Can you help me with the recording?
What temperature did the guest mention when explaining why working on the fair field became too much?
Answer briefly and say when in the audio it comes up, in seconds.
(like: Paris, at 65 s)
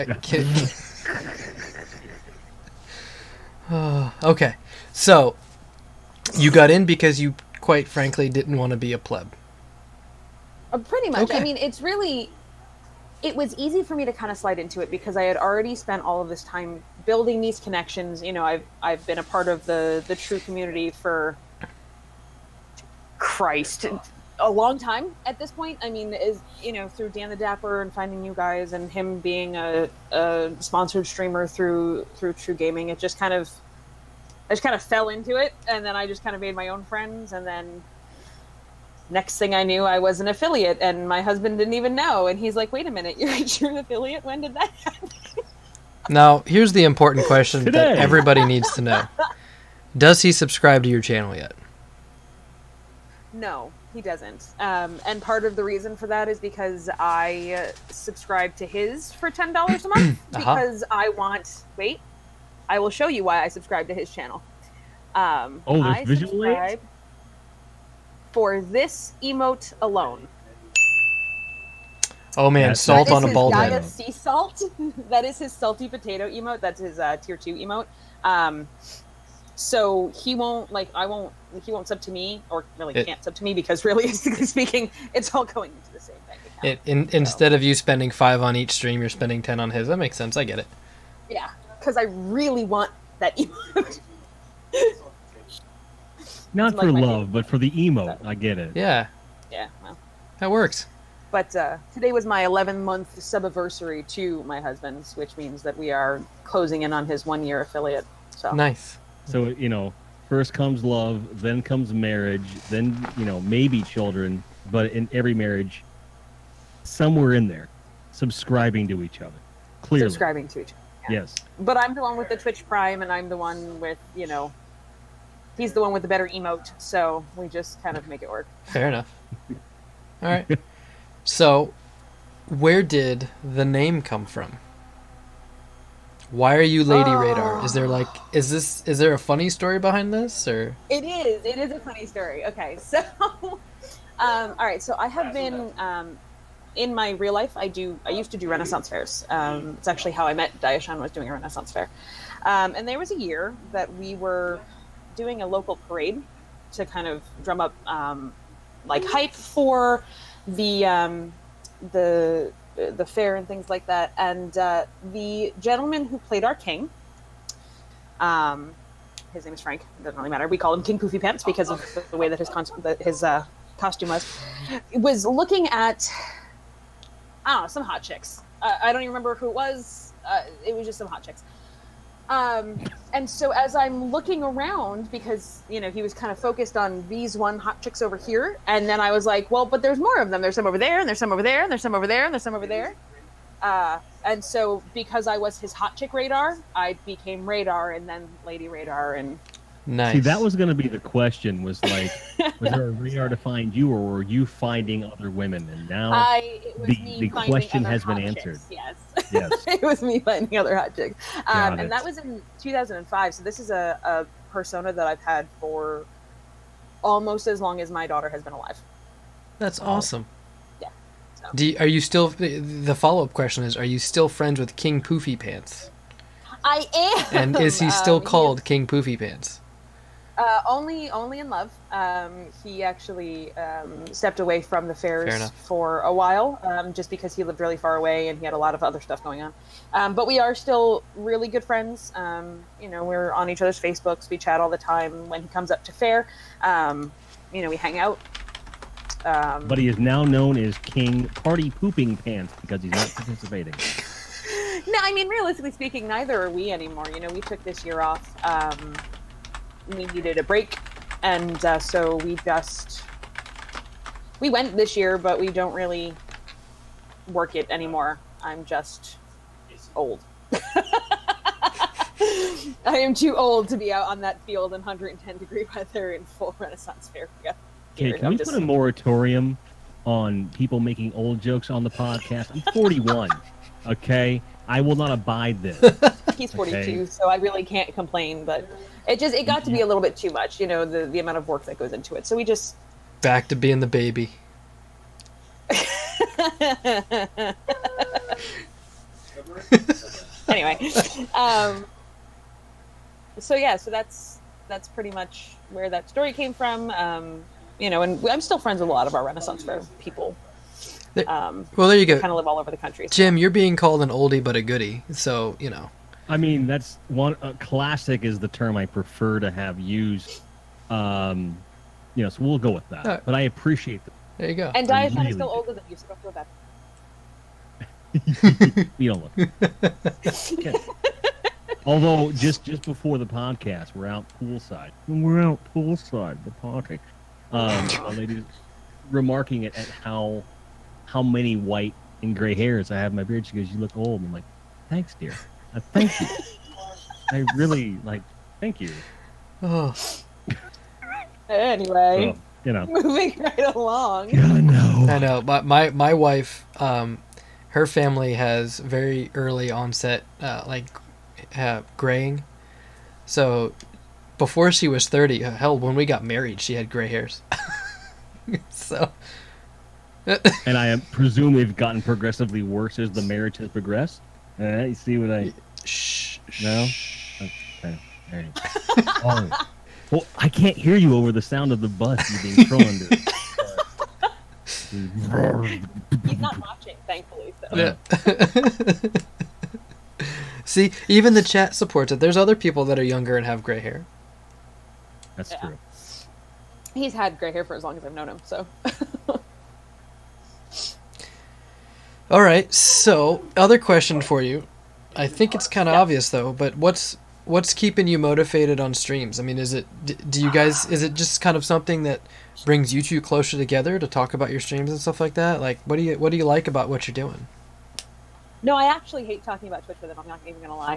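110 degrees, at 274 s.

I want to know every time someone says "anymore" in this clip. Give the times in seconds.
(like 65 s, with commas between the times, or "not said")
256 s, 267 s.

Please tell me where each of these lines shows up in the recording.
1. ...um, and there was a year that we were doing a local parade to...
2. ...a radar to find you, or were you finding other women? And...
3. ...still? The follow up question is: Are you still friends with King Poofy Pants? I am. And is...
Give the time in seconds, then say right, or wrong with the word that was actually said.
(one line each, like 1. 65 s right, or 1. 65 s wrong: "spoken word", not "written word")
1. 152 s right
2. 202 s right
3. 222 s right.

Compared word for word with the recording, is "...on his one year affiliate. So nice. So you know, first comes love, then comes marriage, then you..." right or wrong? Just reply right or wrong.
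right.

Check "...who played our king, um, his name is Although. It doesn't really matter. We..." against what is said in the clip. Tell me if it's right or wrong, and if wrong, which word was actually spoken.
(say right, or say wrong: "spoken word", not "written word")
wrong: "Frank", not "Although".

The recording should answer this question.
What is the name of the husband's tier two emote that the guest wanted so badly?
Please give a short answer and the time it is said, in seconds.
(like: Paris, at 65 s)
salty potato, at 75 s.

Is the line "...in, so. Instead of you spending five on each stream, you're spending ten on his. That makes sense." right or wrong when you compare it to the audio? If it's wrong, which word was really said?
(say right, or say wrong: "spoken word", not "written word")
right.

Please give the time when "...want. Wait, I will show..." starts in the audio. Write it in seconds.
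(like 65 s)
61 s.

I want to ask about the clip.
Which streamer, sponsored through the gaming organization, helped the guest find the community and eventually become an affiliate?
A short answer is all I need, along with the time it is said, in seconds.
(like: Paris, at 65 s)
Dan the Dapper, at 27 s.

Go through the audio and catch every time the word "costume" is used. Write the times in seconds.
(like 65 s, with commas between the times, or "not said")
173 s.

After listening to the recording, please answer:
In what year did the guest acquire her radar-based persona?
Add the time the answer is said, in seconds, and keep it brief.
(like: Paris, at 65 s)
2005, at 212 s.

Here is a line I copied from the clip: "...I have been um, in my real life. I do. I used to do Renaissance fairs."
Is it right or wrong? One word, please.
right.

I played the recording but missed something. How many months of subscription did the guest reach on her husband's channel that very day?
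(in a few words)
11 month.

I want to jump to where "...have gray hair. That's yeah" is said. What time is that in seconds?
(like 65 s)
393 s.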